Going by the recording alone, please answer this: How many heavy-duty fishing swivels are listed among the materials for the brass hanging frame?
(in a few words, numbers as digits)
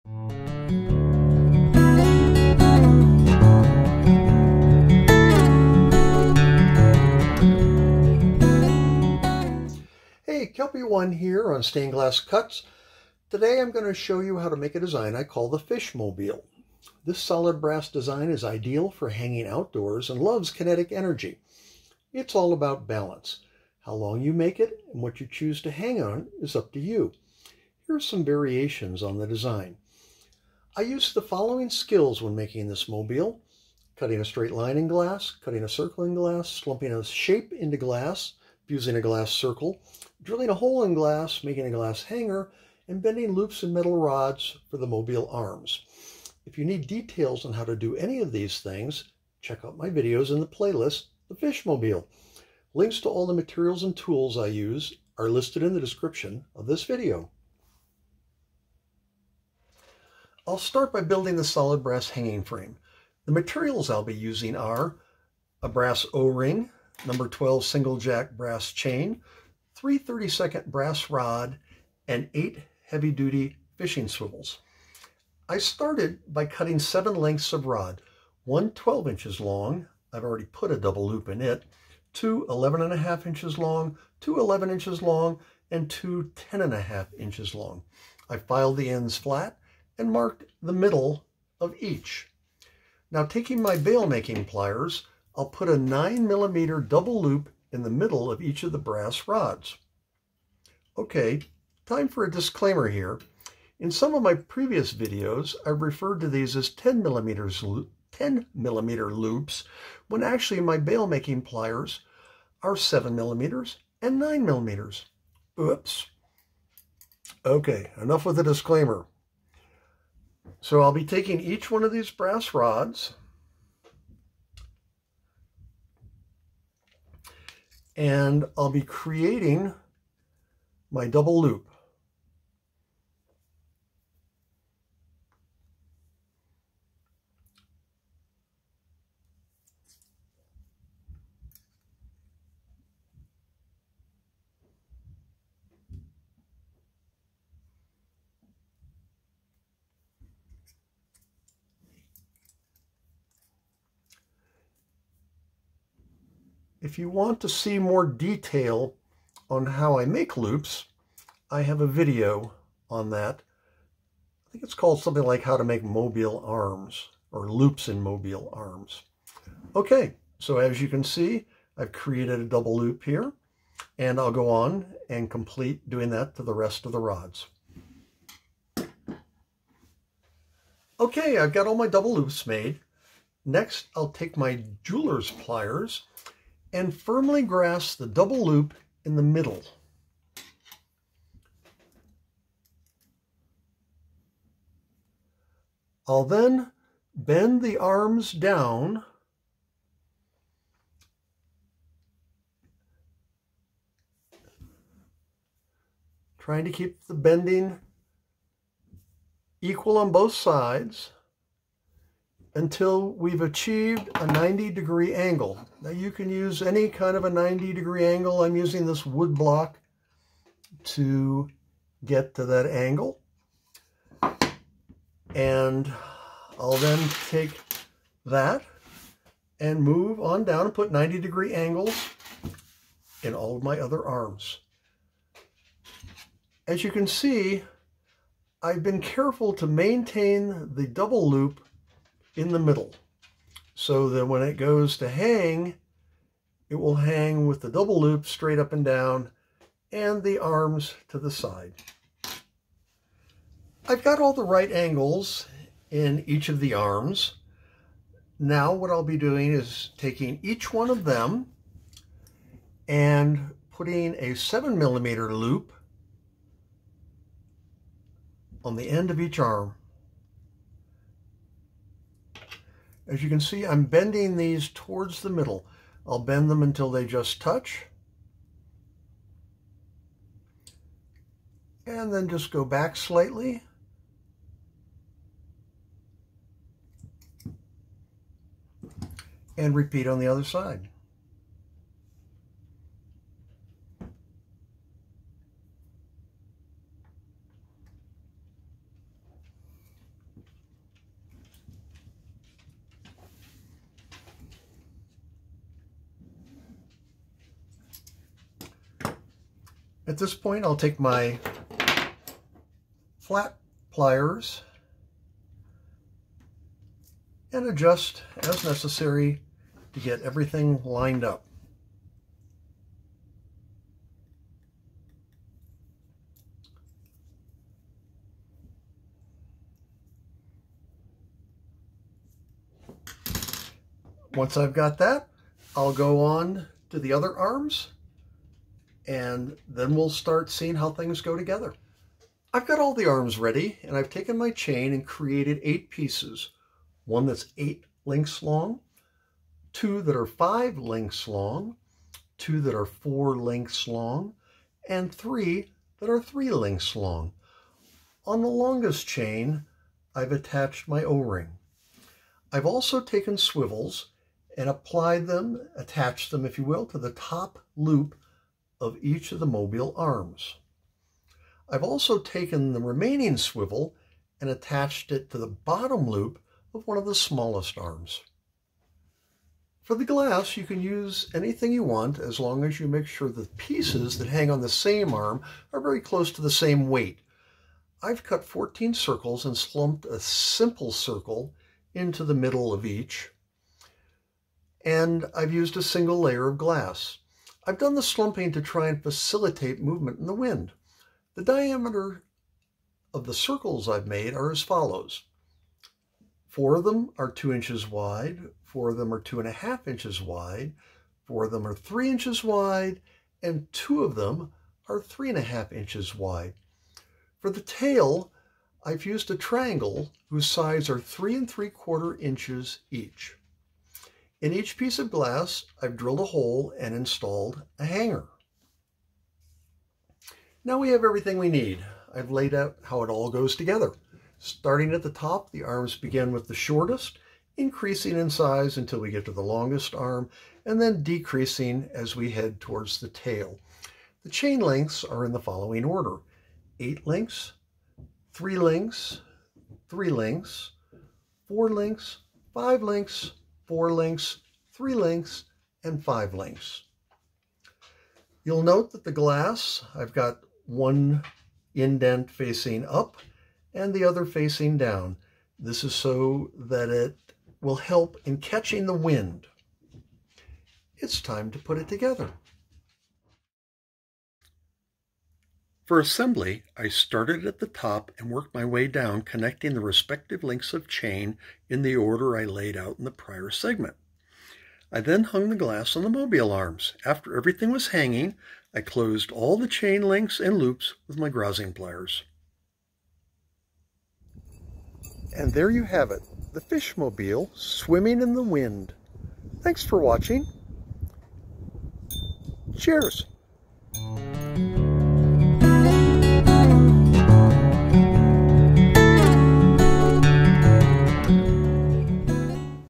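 8.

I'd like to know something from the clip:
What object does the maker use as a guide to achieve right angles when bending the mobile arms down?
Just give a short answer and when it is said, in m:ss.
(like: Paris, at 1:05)
wood block, at 3:39.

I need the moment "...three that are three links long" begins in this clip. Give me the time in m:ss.
5:55.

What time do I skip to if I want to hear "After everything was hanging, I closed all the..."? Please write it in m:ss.
8:07.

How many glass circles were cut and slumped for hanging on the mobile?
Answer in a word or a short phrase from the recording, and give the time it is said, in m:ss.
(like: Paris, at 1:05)
14, at 6:28.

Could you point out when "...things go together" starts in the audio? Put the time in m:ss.
5:40.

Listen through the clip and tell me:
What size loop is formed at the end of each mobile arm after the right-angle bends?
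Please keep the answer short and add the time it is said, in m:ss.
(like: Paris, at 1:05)
7 millimeter, at 4:24.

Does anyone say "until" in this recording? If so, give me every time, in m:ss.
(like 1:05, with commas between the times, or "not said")
3:32, 4:36, 7:18.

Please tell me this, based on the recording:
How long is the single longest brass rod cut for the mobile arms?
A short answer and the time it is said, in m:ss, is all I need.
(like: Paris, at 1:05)
12 inches, at 1:18.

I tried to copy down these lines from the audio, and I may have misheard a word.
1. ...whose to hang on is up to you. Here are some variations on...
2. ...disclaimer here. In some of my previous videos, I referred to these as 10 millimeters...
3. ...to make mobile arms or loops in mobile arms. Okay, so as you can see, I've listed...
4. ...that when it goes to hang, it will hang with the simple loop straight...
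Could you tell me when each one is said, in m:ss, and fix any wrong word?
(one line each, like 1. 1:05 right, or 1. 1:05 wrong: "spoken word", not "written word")
1. 0:25 wrong: "choose", not "whose"
2. 1:42 right
3. 2:45 wrong: "created", not "listed"
4. 4:04 wrong: "double", not "simple".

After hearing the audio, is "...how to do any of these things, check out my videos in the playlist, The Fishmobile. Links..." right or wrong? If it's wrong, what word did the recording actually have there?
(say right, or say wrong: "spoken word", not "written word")
right.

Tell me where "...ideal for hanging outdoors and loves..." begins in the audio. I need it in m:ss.
0:18.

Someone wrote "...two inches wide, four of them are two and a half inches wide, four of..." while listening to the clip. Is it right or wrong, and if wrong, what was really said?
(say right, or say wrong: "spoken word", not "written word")
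right.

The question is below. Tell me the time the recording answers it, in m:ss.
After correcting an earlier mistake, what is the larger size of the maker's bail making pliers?
1:54.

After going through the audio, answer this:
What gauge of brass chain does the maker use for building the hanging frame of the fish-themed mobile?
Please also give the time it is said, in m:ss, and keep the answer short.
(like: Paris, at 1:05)
number 12 single jack, at 1:07.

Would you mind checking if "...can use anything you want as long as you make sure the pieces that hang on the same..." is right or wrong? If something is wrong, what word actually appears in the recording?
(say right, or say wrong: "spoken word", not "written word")
right.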